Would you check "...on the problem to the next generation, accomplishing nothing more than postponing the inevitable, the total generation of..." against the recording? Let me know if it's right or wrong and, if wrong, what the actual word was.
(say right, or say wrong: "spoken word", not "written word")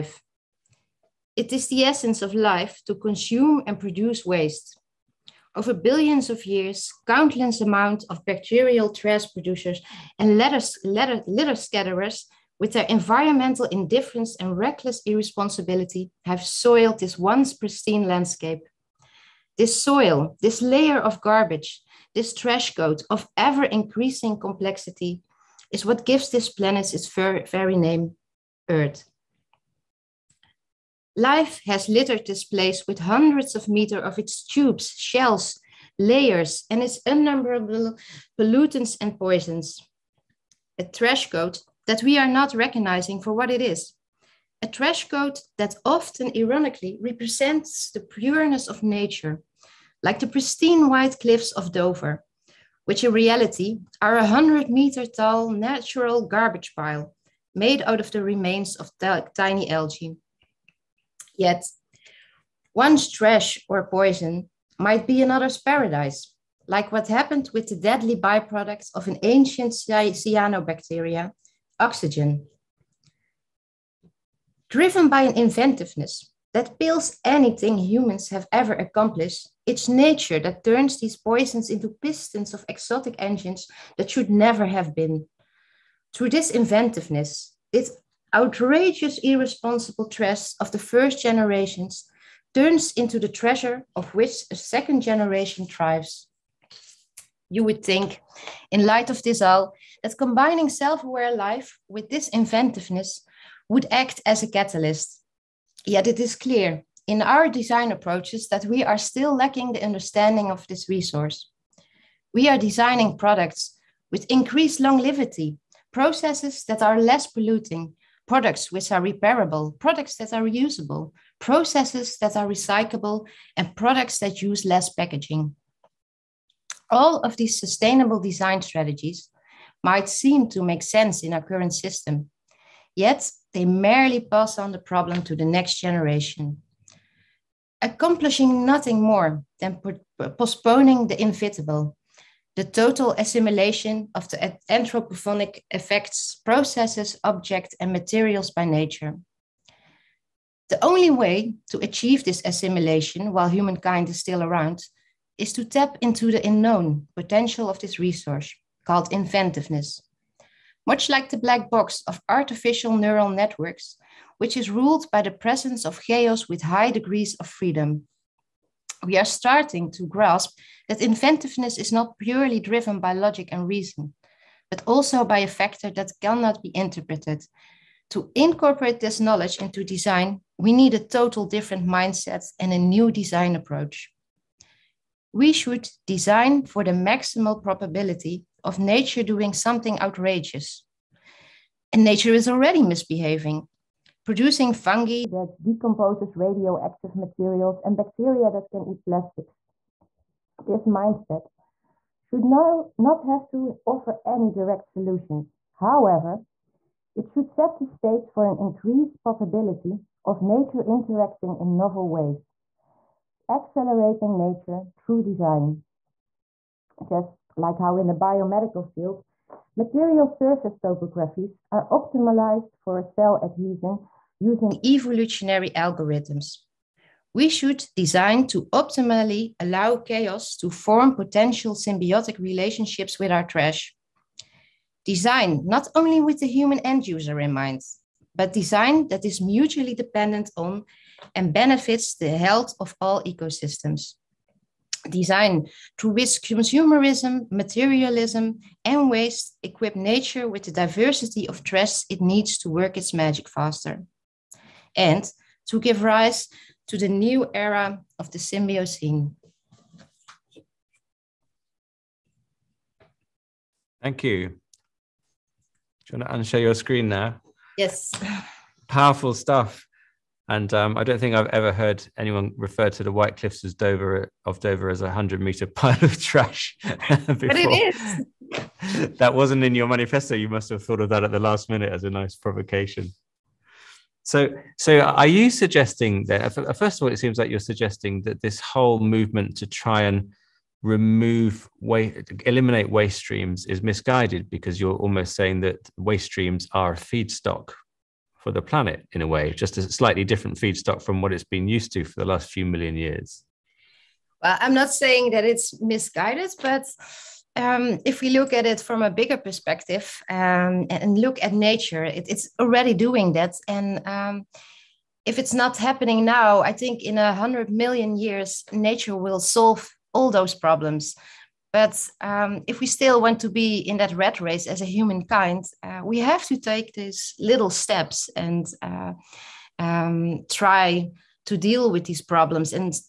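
wrong: "assimilation", not "generation".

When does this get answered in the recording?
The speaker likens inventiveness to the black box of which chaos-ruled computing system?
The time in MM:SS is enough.
02:42.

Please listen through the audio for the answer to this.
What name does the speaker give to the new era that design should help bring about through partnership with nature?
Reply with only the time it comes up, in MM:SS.
04:18.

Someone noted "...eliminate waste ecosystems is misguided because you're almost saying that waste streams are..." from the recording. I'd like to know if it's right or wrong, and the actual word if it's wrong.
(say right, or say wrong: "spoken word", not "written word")
wrong: "streams", not "ecosystems".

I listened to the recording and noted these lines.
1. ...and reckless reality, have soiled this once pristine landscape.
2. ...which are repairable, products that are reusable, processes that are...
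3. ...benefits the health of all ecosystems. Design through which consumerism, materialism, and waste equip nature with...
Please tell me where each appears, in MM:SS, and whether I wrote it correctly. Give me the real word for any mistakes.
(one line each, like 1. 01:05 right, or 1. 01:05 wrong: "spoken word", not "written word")
1. 00:14 wrong: "irresponsibility", not "reality"
2. 01:58 right
3. 04:01 right.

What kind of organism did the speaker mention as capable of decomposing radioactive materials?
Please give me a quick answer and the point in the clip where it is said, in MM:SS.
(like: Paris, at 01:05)
fungi, at 03:14.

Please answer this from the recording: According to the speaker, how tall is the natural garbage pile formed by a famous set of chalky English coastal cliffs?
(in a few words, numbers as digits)
100 meters.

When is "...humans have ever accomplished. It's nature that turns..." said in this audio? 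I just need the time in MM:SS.
01:17.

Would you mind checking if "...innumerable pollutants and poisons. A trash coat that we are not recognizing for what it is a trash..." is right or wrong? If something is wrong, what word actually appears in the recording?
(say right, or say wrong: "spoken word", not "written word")
right.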